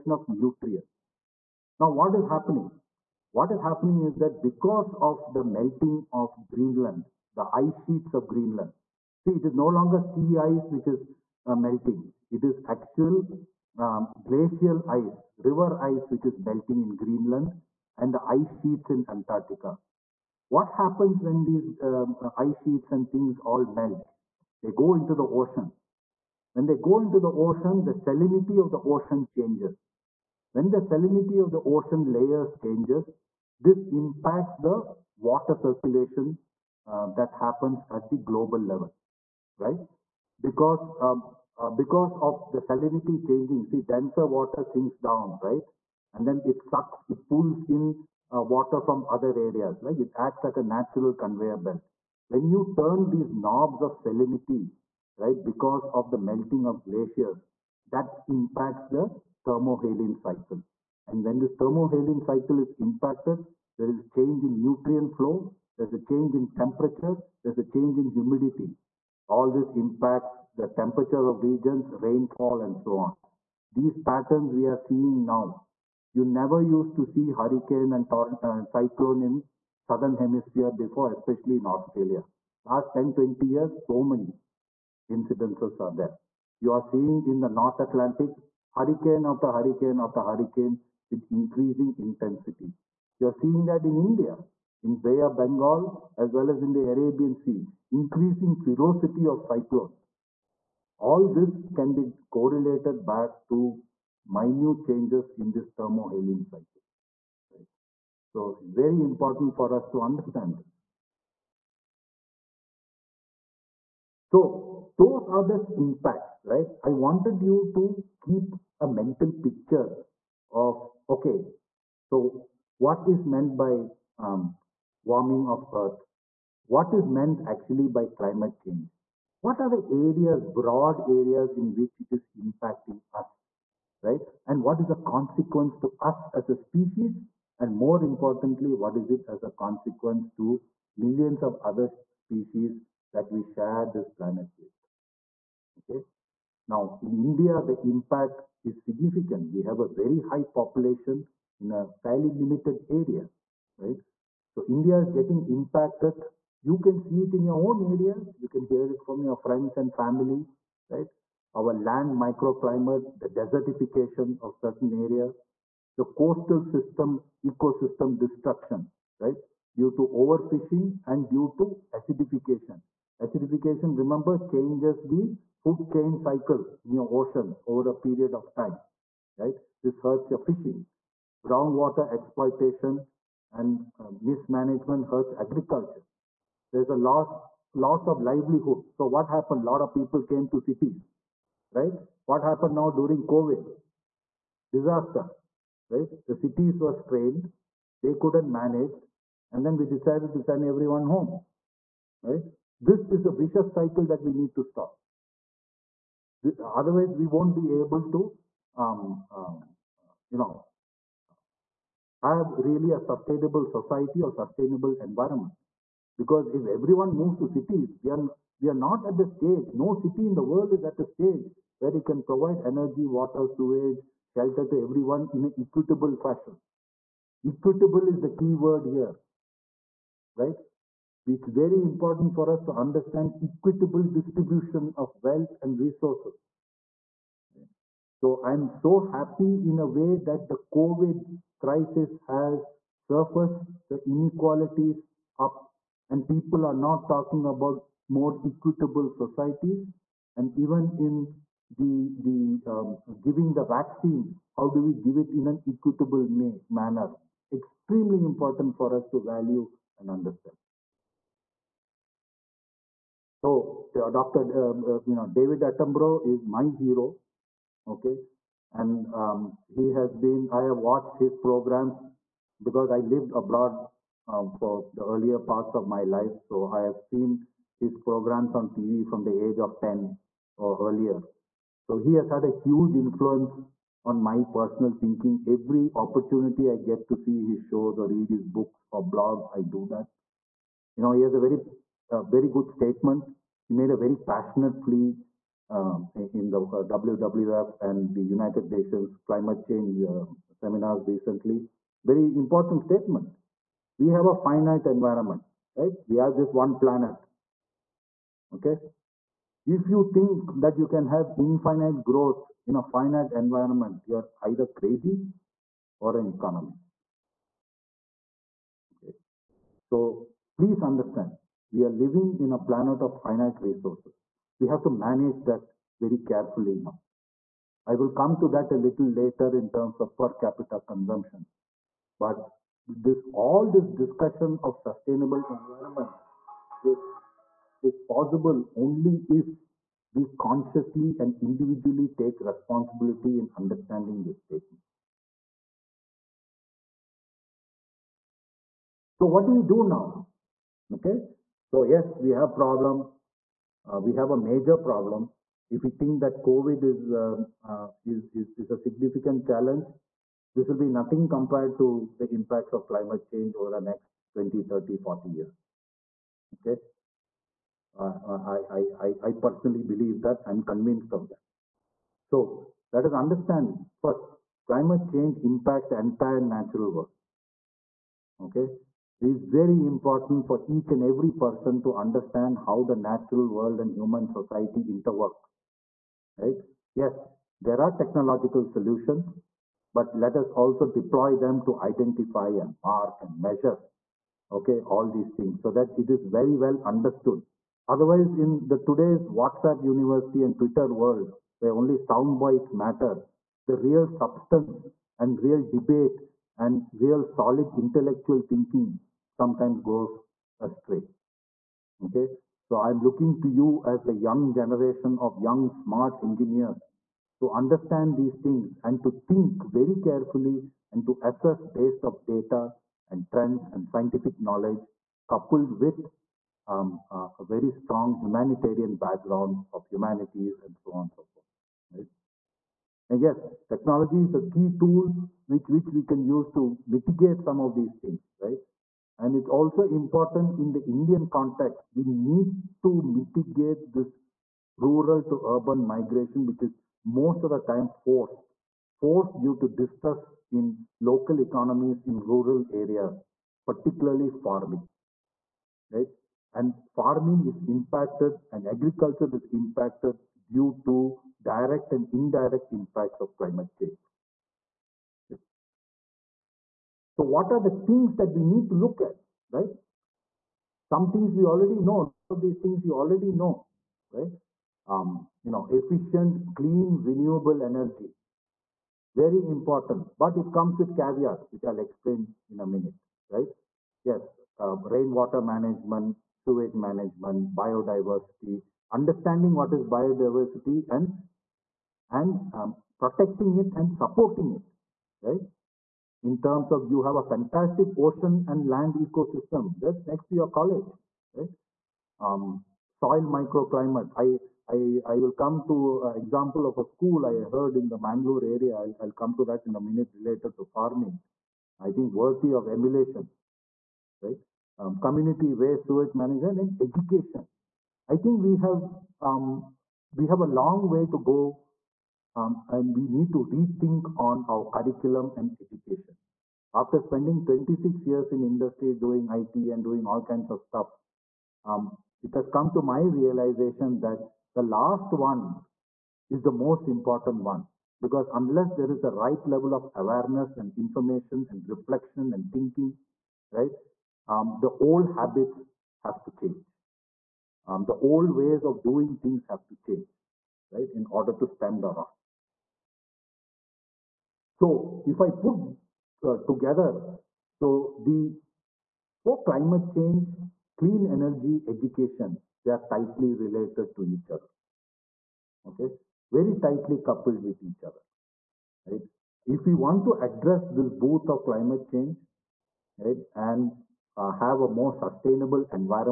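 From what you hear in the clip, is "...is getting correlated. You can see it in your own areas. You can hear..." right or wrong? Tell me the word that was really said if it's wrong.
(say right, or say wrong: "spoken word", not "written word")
wrong: "impacted", not "correlated".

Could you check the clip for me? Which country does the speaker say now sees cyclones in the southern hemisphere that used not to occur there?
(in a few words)
Australia.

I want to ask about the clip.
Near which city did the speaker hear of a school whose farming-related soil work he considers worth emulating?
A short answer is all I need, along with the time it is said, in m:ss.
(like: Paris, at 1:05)
Mangalore, at 8:28.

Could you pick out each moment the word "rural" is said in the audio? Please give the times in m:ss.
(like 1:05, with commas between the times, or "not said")
7:24, 7:32.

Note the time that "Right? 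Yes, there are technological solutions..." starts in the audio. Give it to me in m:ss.
6:26.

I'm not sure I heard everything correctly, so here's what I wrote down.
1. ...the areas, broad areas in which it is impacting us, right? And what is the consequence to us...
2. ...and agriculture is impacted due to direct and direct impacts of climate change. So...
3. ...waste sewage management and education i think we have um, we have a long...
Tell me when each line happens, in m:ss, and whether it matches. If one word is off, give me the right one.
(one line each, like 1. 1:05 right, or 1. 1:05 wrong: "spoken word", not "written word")
1. 2:09 right
2. 7:38 wrong: "indirect", not "direct"
3. 8:35 right.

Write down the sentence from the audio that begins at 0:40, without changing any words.
Because um, uh, because of the salinity changing, see, denser water sinks down, right?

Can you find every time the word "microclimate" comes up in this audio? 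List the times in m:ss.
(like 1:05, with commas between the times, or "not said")
2:42, 8:23.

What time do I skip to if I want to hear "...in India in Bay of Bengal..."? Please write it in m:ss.
1:33.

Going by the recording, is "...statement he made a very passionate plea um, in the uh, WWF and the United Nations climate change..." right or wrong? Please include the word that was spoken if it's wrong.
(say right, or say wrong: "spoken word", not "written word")
right.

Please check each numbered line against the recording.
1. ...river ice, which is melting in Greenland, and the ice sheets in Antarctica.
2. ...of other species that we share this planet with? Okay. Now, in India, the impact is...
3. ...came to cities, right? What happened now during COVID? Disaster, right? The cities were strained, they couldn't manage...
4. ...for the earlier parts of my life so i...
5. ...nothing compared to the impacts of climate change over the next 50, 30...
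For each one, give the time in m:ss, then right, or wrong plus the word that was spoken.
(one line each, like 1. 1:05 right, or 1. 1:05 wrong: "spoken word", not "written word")
1. 0:15 right
2. 2:21 right
3. 3:10 right
4. 4:34 right
5. 6:00 wrong: "20", not "50".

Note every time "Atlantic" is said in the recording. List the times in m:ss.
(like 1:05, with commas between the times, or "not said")
1:27.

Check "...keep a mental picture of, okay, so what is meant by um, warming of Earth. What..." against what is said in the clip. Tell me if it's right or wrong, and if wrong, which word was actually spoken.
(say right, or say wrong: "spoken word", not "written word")
right.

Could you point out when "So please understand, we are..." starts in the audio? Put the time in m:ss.
5:19.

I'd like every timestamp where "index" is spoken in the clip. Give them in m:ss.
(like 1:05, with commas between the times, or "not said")
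not said.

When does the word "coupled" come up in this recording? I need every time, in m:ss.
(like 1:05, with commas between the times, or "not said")
7:05, 9:26.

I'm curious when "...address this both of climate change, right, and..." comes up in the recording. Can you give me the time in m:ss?
9:30.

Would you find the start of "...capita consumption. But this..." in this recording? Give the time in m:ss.
5:30.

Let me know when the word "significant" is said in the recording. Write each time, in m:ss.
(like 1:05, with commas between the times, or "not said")
2:28, 5:58.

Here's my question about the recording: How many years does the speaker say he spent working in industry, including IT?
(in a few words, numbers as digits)
26.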